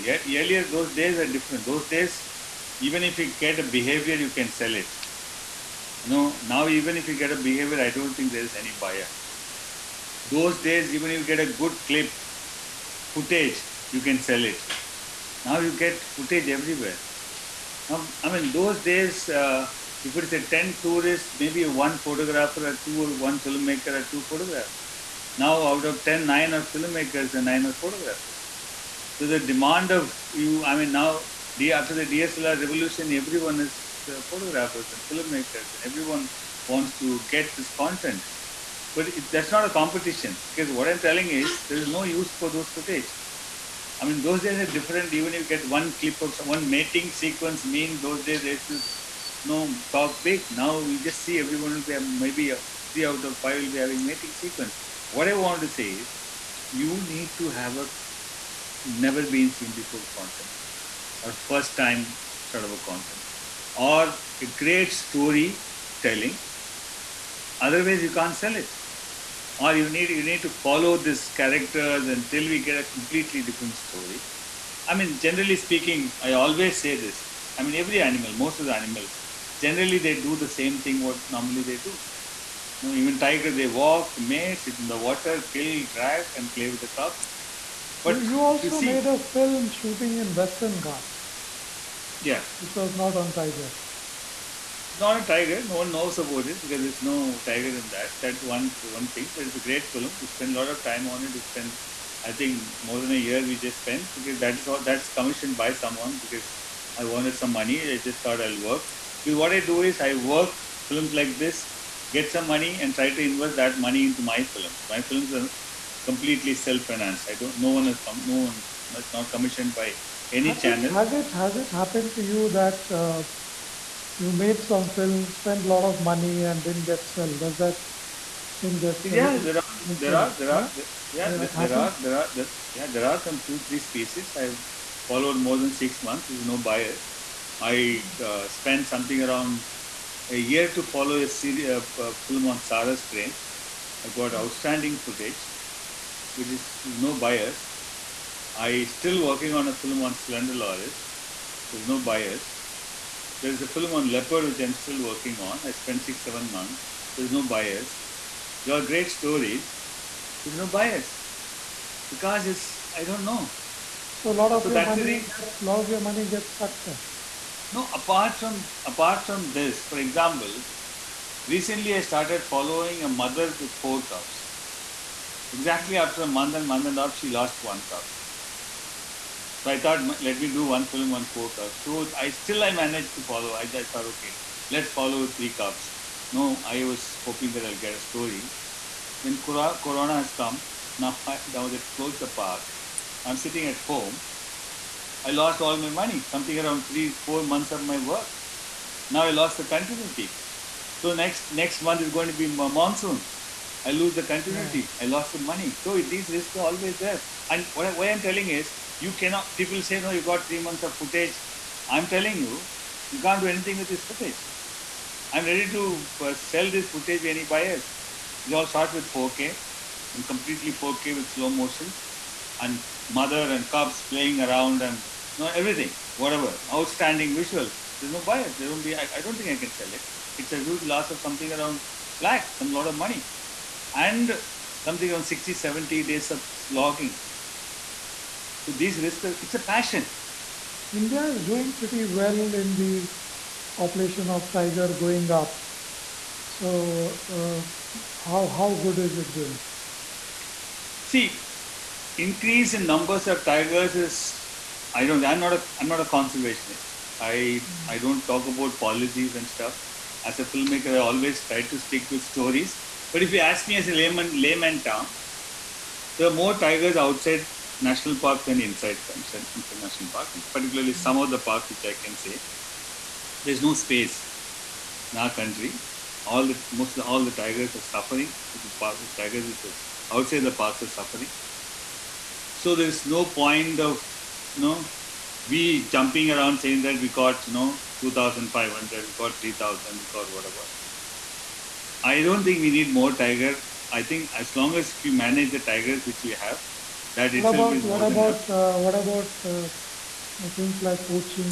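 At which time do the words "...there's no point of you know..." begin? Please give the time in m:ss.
4:42.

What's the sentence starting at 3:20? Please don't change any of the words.
So next next month is going to be monsoon.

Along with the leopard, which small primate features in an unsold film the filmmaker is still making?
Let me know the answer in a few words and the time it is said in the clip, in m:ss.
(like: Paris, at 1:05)
Slender Loris, at 2:30.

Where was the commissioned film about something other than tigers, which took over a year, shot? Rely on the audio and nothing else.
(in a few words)
Western Ghats.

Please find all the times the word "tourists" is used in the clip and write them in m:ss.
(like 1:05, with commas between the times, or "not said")
0:20.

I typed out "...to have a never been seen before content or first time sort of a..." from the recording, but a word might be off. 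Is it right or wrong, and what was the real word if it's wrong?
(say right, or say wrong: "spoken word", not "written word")
right.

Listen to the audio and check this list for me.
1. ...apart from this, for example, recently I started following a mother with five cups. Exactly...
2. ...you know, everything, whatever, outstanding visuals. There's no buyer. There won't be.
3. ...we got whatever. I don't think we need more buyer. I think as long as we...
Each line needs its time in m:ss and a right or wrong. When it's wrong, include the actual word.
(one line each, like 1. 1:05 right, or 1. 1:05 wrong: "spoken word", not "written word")
1. 2:48 wrong: "four", not "five"
2. 3:45 right
3. 4:49 wrong: "tiger", not "buyer".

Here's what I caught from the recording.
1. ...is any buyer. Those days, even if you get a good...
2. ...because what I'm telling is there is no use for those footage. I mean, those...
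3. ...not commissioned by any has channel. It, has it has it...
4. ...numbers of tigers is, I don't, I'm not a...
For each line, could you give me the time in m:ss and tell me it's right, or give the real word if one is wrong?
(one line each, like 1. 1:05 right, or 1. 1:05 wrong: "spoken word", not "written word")
1. 0:08 right
2. 0:40 right
3. 1:59 right
4. 4:12 right.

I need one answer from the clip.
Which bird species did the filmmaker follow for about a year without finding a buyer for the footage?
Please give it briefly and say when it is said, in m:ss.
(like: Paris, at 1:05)
Sarus crane, at 2:22.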